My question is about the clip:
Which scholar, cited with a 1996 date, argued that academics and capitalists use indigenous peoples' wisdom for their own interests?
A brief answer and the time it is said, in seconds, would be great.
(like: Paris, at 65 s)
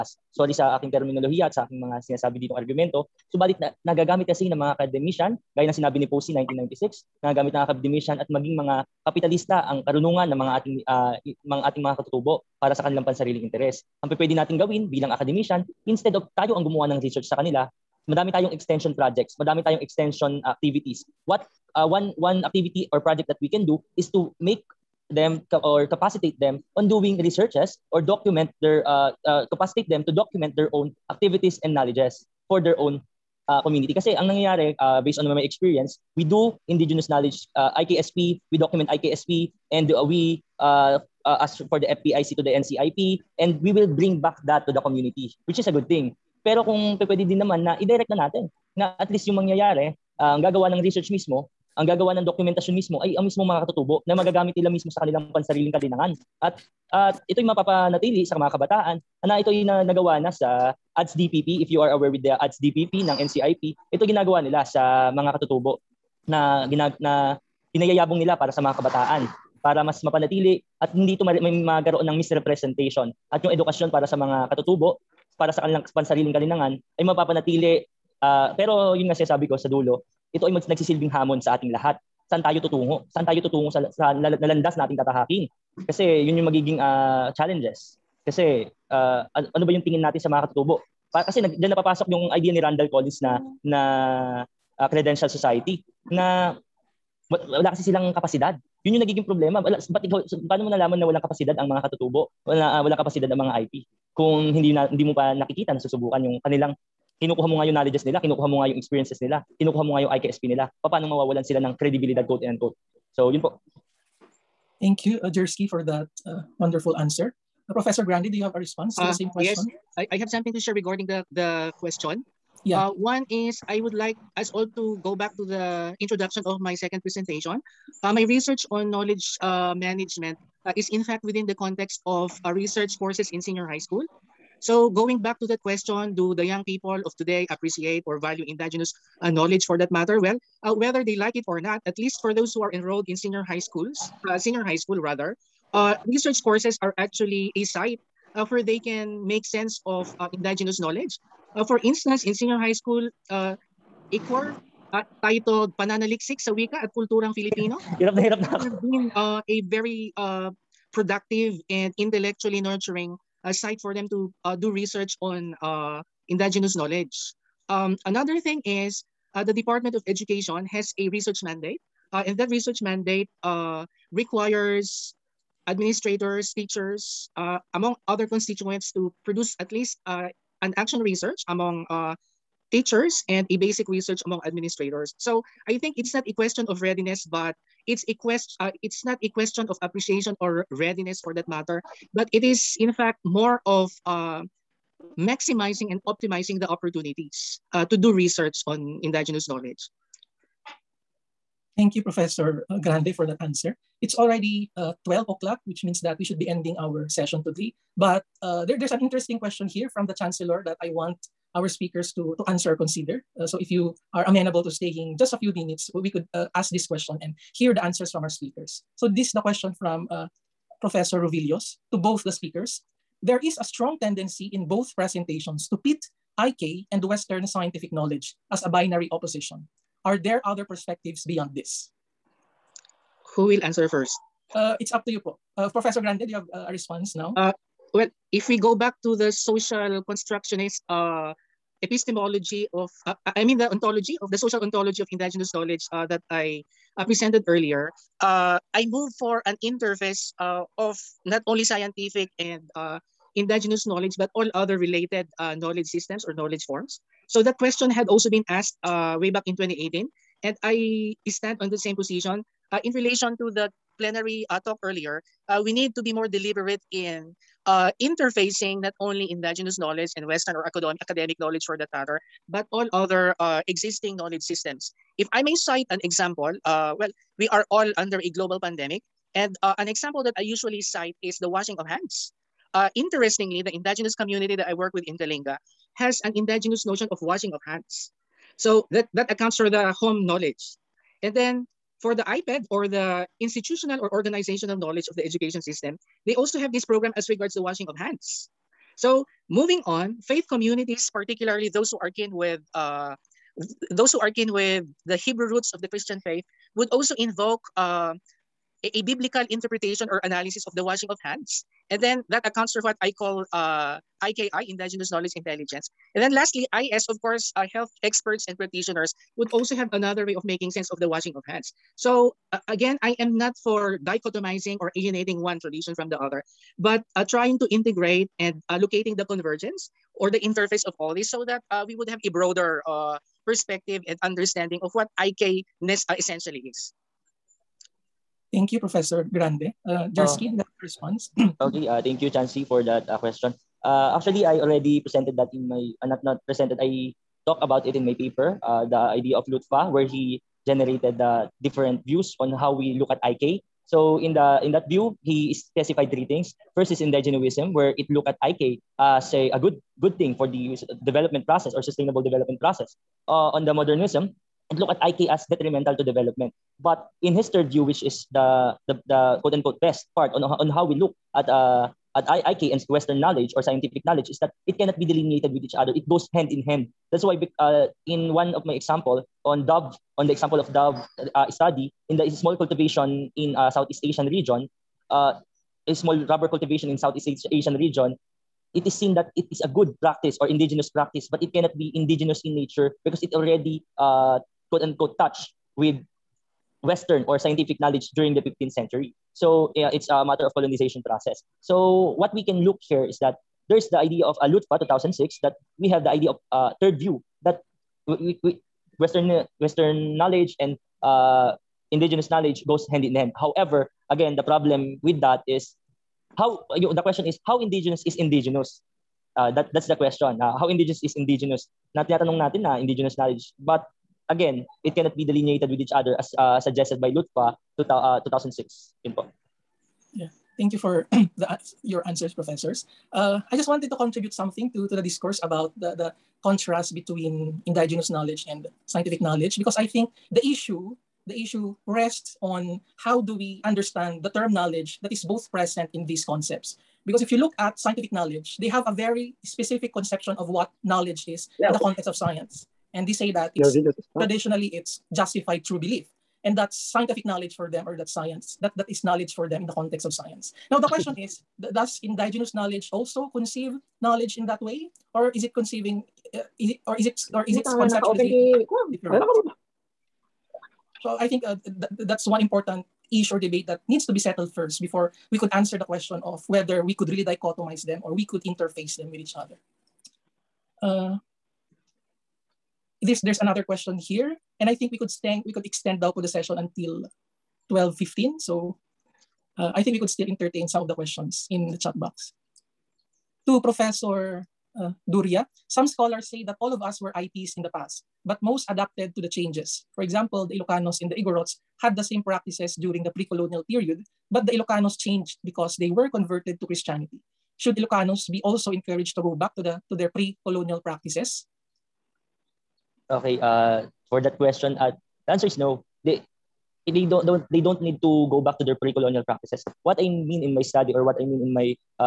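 Posey, at 6 s.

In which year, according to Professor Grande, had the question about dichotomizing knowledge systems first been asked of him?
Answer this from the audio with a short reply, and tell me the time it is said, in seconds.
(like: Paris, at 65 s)
2018, at 259 s.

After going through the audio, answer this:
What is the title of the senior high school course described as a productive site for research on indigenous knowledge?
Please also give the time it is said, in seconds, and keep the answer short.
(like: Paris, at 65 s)
Pananaliksik sa Wika at Kulturang Filipino, at 155 s.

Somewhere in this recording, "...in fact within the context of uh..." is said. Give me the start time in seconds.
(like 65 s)
130 s.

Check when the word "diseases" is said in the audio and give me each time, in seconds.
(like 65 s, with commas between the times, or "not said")
not said.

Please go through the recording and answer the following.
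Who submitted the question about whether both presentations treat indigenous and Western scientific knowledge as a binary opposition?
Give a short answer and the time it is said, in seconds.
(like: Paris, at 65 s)
Professor Rovillos, at 220 s.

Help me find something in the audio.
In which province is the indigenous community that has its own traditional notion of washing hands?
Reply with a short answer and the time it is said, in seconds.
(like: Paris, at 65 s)
Kalinga, at 285 s.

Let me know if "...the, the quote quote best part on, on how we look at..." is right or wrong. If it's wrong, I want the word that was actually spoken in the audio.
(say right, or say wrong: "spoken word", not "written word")
wrong: "unquote", not "quote".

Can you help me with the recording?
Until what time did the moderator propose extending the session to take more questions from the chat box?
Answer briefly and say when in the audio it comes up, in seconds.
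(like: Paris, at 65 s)
12:15, at 487 s.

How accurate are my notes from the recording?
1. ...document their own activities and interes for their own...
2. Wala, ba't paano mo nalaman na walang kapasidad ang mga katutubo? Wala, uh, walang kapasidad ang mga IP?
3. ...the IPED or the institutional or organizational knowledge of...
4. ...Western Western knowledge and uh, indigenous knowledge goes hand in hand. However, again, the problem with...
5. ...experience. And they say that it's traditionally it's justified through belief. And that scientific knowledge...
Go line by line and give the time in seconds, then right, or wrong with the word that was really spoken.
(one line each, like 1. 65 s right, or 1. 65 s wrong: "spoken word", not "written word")
1. 30 s wrong: "knowledges", not "interes"
2. 99 s right
3. 292 s right
4. 408 s right
5. 452 s wrong: "science", not "experience".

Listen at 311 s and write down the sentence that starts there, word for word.
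And then that accounts for what I call uh, IKI, Indigenous Knowledge Intelligence.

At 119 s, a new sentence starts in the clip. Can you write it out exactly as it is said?
Yes, I, I have something to share regarding the, the question.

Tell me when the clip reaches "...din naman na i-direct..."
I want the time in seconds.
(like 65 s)
47 s.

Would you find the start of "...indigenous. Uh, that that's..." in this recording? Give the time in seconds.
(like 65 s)
418 s.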